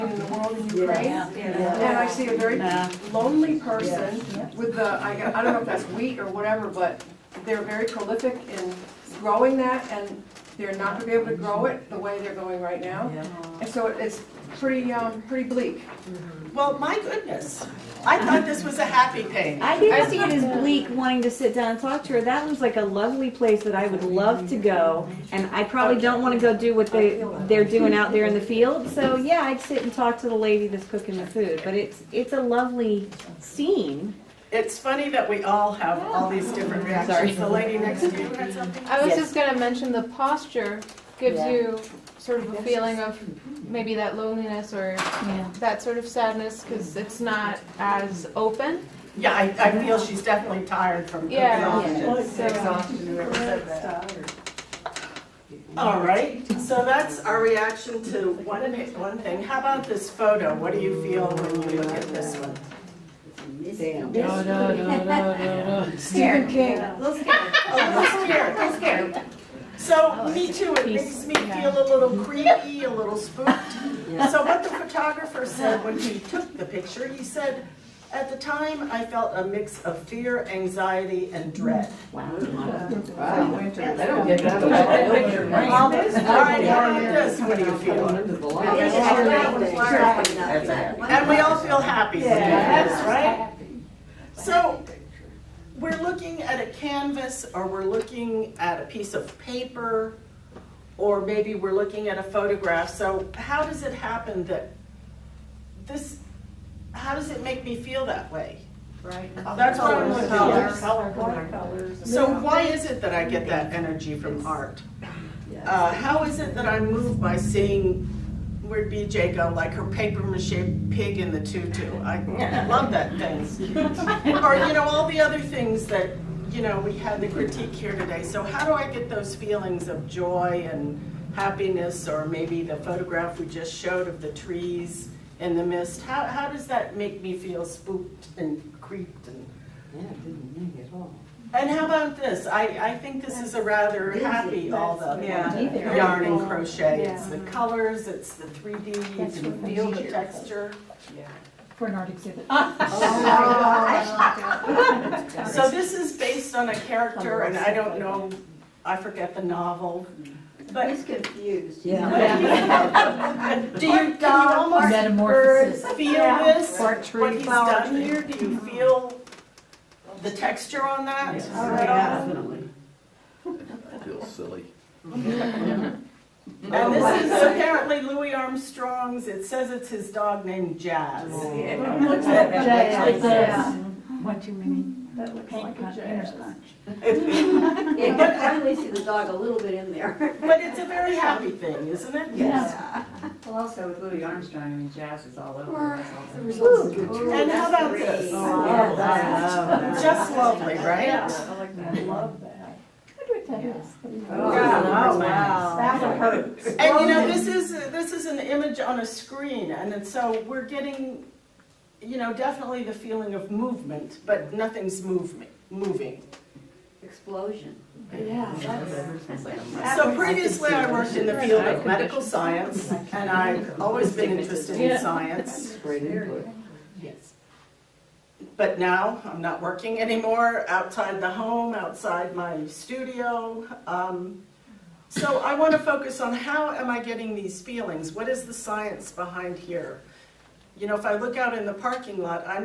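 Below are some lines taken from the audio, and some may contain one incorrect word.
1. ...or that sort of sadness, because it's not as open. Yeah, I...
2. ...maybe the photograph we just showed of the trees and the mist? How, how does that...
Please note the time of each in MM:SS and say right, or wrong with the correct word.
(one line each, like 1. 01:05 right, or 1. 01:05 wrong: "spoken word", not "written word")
1. 00:44 right
2. 02:12 right.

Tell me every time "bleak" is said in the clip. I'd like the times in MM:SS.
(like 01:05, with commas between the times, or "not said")
00:15, 00:20.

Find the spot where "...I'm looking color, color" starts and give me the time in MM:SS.
01:49.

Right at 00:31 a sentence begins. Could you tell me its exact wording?
But it's it's a lovely scene.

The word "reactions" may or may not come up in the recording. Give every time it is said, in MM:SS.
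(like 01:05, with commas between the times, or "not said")
00:36, 00:57.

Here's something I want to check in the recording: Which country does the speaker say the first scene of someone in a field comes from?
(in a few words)
Ukraine.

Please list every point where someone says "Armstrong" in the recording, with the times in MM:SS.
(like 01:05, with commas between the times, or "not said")
02:58, 03:14.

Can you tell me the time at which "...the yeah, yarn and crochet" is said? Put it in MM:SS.
02:24.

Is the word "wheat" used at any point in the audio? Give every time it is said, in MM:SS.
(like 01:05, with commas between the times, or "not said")
00:05.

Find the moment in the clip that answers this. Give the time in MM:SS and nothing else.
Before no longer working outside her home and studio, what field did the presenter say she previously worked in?
03:41.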